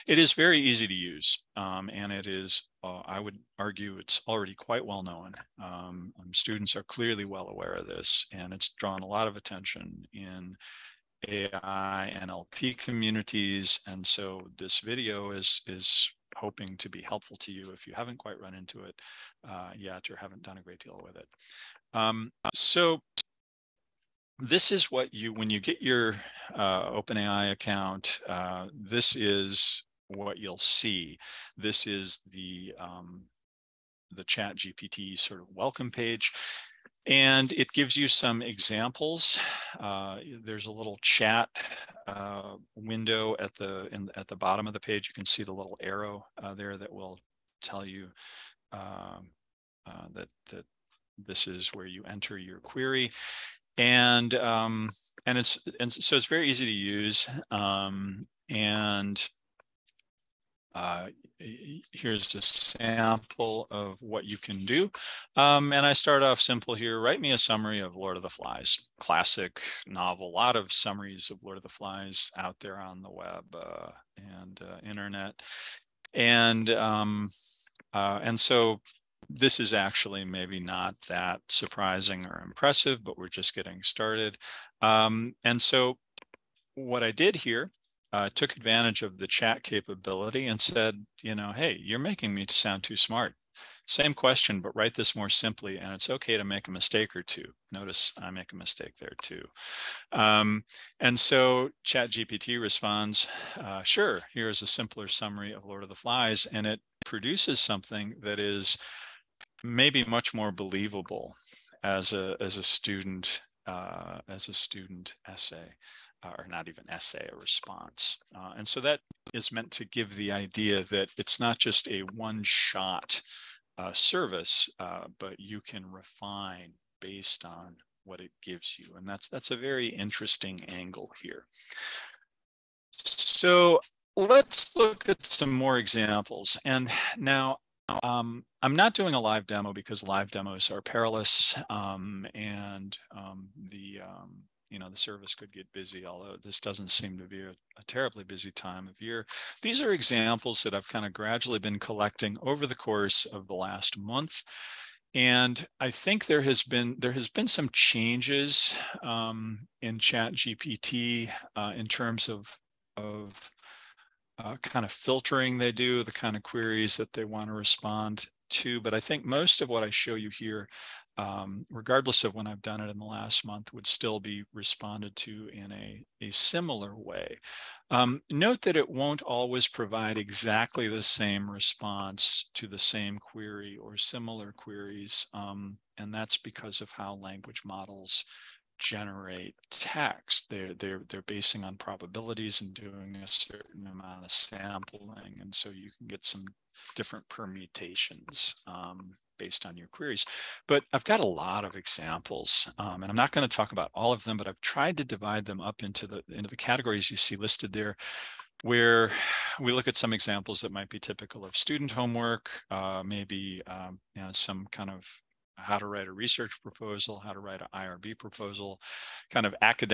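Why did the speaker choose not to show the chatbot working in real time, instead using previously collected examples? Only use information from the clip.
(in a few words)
live demos are perilous.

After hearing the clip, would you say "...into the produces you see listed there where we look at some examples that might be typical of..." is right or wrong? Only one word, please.
wrong.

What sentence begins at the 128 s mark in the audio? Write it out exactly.
And that's, that's a very interesting angle here.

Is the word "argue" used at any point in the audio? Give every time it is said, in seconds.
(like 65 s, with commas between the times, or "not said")
3 s.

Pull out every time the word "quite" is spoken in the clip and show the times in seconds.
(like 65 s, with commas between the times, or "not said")
4 s, 18 s.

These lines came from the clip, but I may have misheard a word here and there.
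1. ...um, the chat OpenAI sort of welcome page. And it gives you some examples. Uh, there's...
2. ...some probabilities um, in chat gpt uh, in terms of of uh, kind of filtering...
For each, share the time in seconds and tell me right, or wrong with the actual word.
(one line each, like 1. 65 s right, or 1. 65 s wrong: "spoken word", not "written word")
1. 32 s wrong: "GPT", not "OpenAI"
2. 157 s wrong: "changes", not "probabilities".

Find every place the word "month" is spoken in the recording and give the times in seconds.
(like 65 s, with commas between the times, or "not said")
153 s, 173 s.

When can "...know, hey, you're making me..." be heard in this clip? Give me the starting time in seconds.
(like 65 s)
91 s.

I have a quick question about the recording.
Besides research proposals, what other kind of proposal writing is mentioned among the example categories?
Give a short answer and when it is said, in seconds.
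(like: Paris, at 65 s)
IRB proposal, at 217 s.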